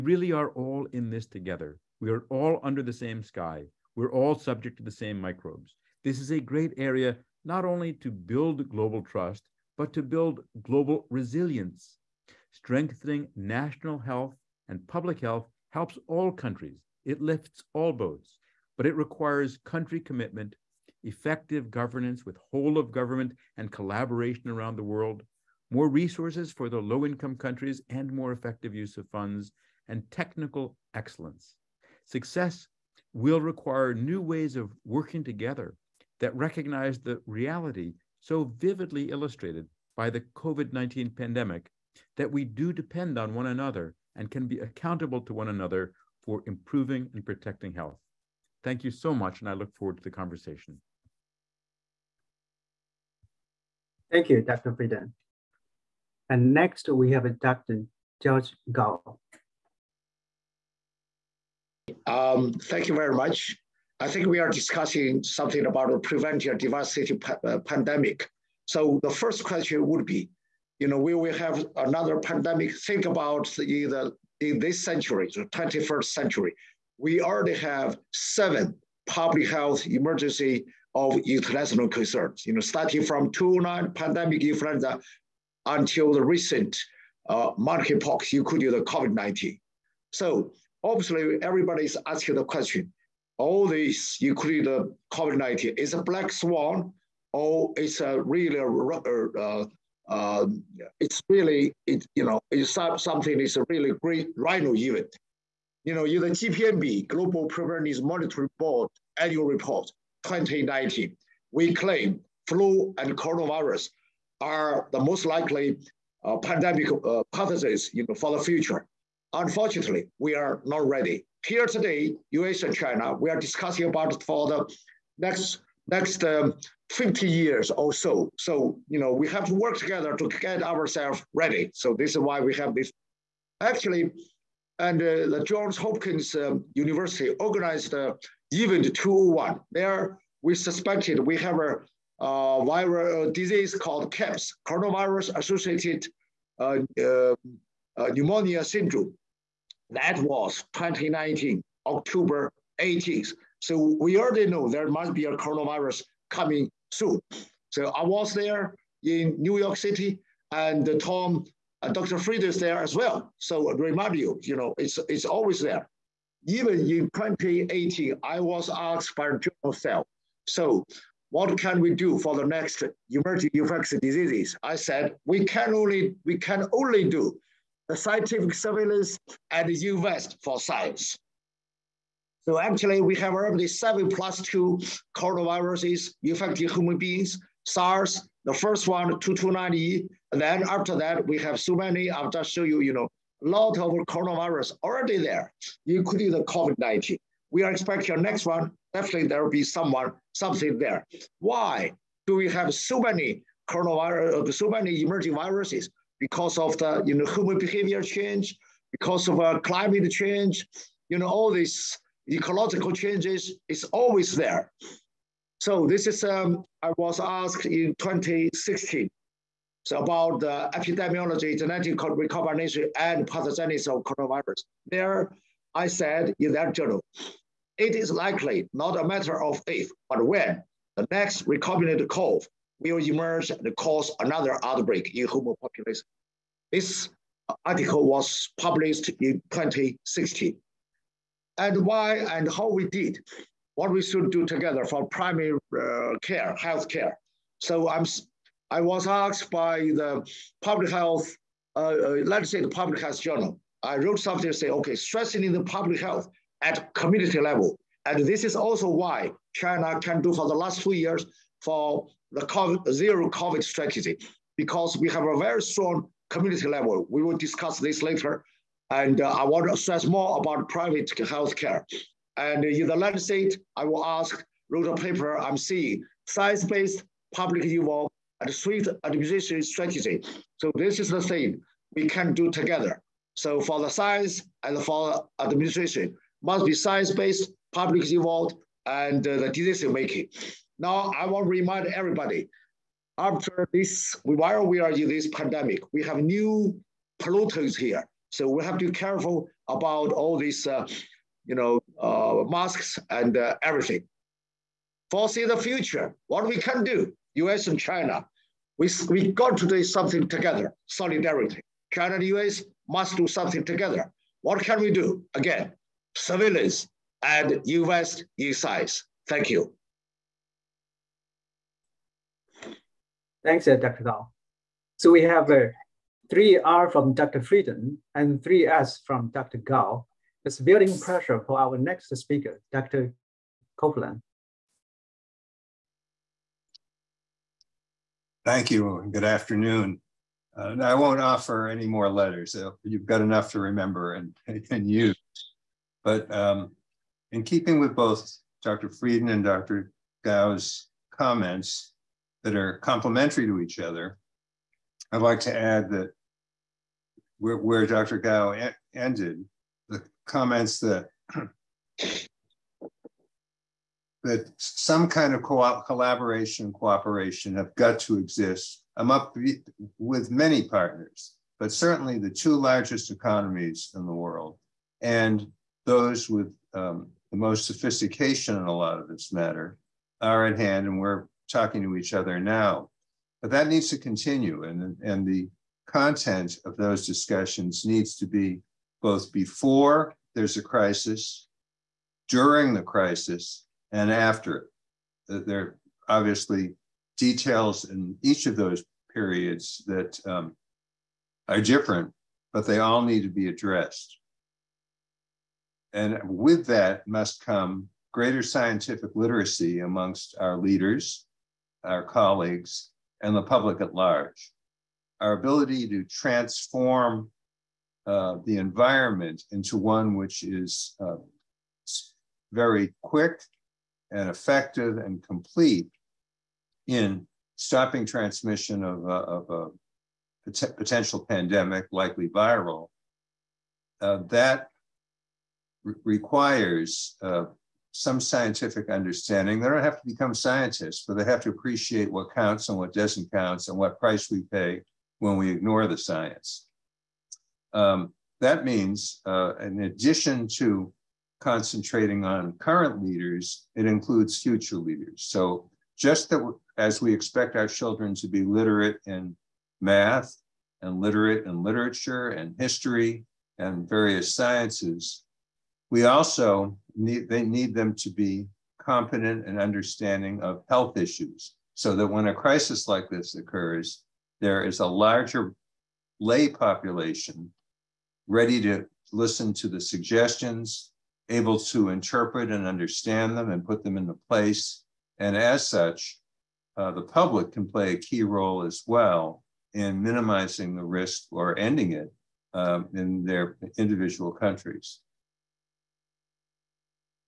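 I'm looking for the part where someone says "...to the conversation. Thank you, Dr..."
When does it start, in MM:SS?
00:49.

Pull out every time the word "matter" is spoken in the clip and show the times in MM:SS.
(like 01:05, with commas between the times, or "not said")
03:49, 06:19.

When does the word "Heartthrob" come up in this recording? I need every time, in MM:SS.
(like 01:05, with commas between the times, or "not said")
not said.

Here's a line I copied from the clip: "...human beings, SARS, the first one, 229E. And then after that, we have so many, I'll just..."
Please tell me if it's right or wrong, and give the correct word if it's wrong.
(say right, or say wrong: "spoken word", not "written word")
right.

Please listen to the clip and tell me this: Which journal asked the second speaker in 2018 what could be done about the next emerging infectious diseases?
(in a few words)
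Cell.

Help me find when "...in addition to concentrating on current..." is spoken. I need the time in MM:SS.
07:29.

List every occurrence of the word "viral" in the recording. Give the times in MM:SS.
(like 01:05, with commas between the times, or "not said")
02:22, 07:12.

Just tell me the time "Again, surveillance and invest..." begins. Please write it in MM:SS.
05:15.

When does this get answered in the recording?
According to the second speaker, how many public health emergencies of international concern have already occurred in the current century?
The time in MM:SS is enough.
01:18.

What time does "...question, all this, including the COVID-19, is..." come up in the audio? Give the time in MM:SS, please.
01:32.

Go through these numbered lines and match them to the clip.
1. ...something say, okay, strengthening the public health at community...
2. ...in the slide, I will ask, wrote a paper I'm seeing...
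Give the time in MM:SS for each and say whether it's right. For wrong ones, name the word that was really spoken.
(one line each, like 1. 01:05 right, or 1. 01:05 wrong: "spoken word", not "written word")
1. 04:14 right
2. 04:32 right.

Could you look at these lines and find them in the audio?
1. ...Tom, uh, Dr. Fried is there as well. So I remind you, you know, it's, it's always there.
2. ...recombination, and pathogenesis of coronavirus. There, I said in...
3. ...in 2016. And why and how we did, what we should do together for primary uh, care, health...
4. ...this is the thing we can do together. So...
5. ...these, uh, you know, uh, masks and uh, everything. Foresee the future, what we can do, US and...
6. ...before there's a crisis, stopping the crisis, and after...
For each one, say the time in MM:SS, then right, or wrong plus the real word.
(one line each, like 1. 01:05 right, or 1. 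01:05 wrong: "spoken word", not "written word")
1. 02:40 right
2. 03:42 right
3. 03:59 right
4. 04:40 right
5. 05:00 right
6. 06:29 wrong: "during", not "stopping".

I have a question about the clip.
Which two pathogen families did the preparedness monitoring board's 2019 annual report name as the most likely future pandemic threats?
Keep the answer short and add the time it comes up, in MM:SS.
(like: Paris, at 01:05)
flu and coronavirus, at 01:52.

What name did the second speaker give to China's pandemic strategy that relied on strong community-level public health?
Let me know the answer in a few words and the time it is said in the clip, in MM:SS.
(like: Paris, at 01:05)
zero COVID strategy, at 04:22.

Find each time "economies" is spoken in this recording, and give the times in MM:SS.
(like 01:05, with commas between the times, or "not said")
06:13.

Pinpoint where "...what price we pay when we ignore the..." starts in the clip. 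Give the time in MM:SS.
07:23.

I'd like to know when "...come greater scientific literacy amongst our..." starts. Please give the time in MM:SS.
06:47.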